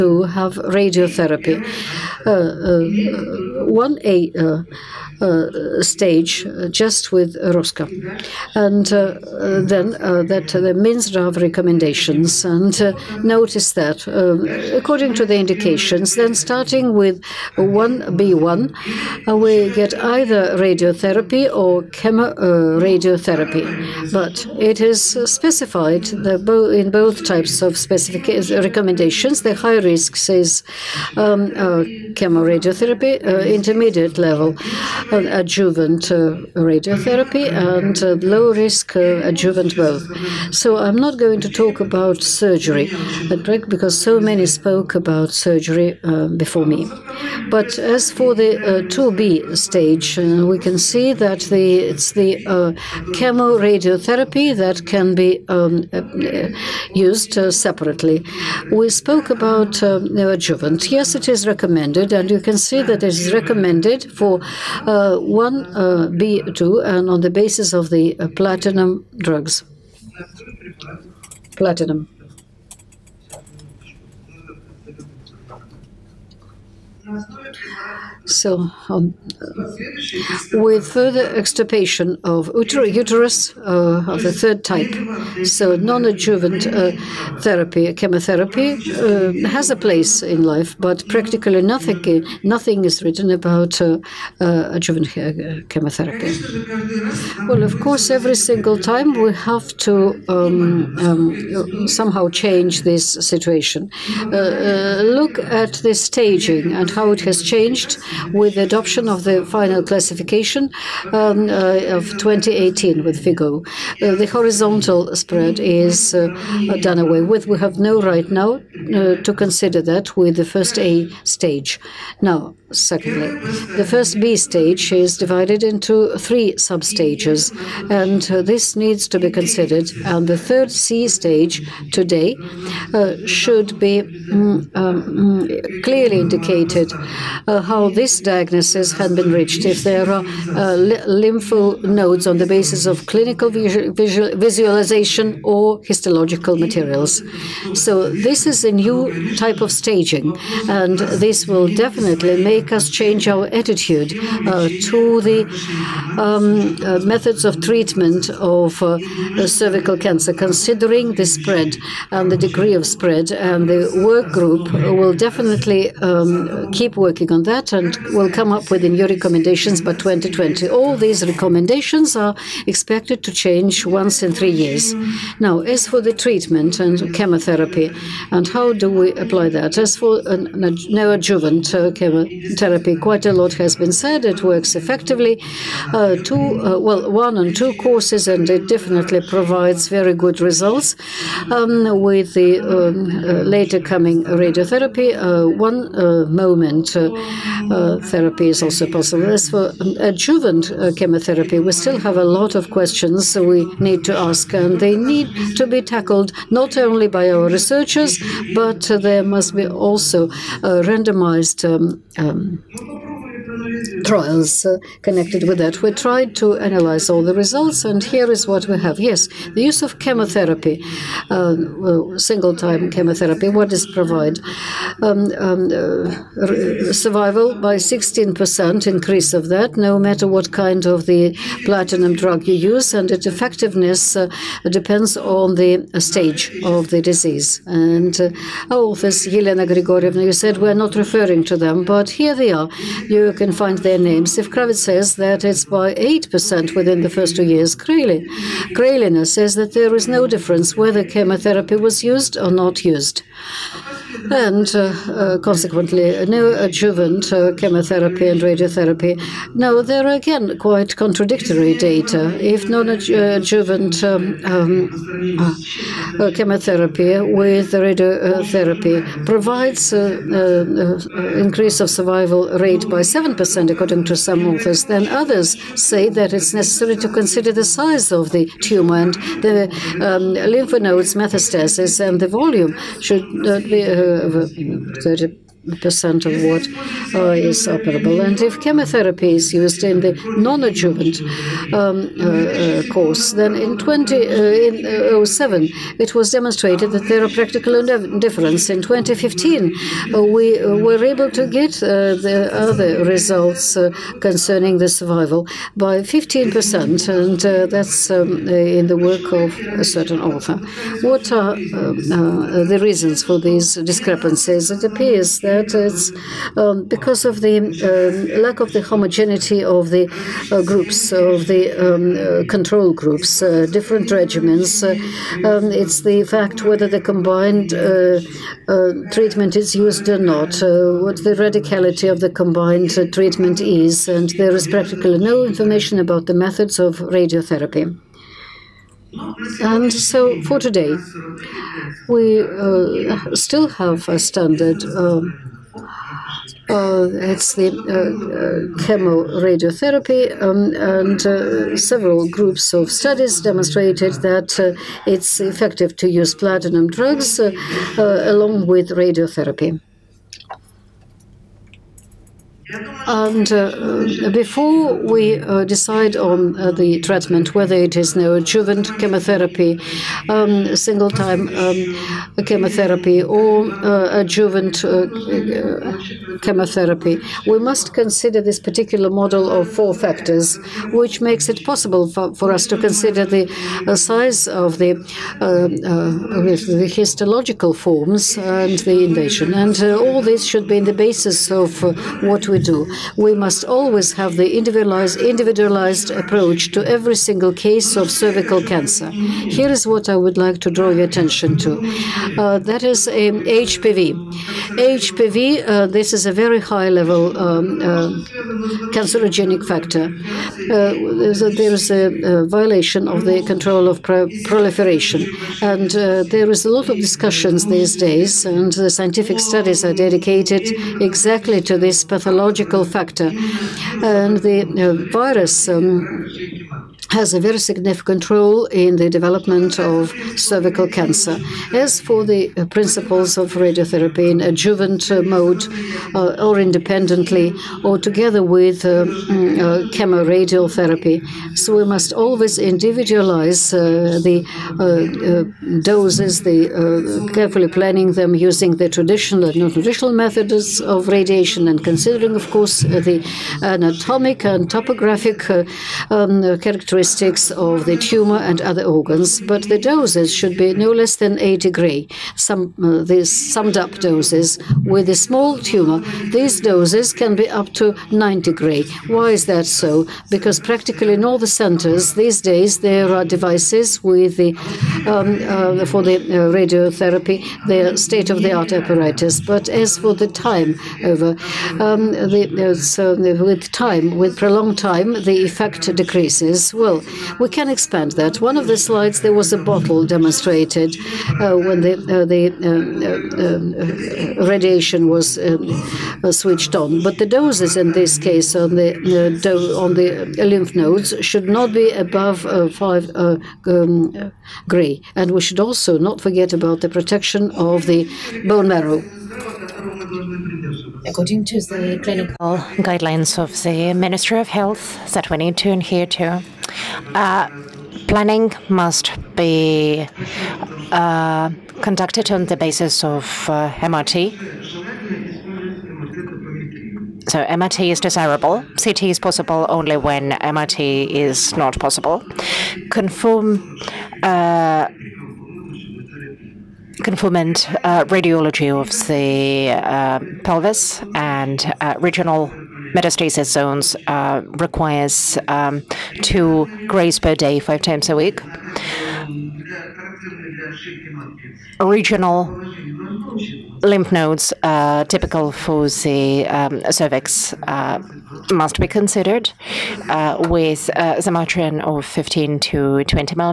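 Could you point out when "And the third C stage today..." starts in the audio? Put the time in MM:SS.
02:10.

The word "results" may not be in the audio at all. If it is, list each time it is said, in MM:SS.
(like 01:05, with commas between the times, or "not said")
03:10, 03:37, 05:03.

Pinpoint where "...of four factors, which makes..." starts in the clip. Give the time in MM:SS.
06:19.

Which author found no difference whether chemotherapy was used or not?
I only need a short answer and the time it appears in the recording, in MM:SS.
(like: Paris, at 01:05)
Krelina, at 04:07.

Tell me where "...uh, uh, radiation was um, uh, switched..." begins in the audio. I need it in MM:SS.
08:13.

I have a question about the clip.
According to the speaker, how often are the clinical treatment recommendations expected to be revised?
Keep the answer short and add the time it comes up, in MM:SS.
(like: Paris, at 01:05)
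once in three years, at 02:53.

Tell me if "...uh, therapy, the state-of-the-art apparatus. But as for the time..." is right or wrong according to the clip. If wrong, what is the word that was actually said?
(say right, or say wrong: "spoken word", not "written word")
wrong: "radiotherapy", not "therapy".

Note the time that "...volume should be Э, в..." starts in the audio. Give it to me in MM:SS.
04:42.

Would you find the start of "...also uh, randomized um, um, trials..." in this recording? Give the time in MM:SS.
03:29.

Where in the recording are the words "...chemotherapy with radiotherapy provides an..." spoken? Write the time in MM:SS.
04:26.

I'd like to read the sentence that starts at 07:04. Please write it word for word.
And the uh, virus um, has a very significant role in the development of cervical cancer.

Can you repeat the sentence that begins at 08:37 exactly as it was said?
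Uh, planning must be uh, conducted on the basis of uh, MRT.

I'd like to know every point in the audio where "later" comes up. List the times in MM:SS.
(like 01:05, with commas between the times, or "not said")
03:13.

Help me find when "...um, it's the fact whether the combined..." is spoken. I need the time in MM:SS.
05:25.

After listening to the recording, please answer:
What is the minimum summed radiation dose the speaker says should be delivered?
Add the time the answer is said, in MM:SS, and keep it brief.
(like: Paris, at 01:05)
80 gray, at 07:41.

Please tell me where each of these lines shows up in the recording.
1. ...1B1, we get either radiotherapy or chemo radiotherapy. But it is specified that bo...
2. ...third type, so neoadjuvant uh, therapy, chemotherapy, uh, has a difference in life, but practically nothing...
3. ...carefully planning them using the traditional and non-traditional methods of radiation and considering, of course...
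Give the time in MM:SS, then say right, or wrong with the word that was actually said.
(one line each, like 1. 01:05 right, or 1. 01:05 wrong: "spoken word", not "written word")
1. 00:17 right
2. 01:24 wrong: "place", not "difference"
3. 07:27 right.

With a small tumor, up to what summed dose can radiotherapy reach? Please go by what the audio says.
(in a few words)
90 gray.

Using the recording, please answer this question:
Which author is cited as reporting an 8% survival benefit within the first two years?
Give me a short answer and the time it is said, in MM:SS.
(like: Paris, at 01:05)
Kravitz, at 04:04.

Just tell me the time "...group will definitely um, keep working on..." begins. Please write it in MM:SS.
02:44.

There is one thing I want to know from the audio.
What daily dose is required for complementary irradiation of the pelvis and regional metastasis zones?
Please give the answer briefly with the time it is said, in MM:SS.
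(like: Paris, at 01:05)
2 grays, at 09:06.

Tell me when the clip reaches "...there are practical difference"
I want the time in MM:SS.
04:57.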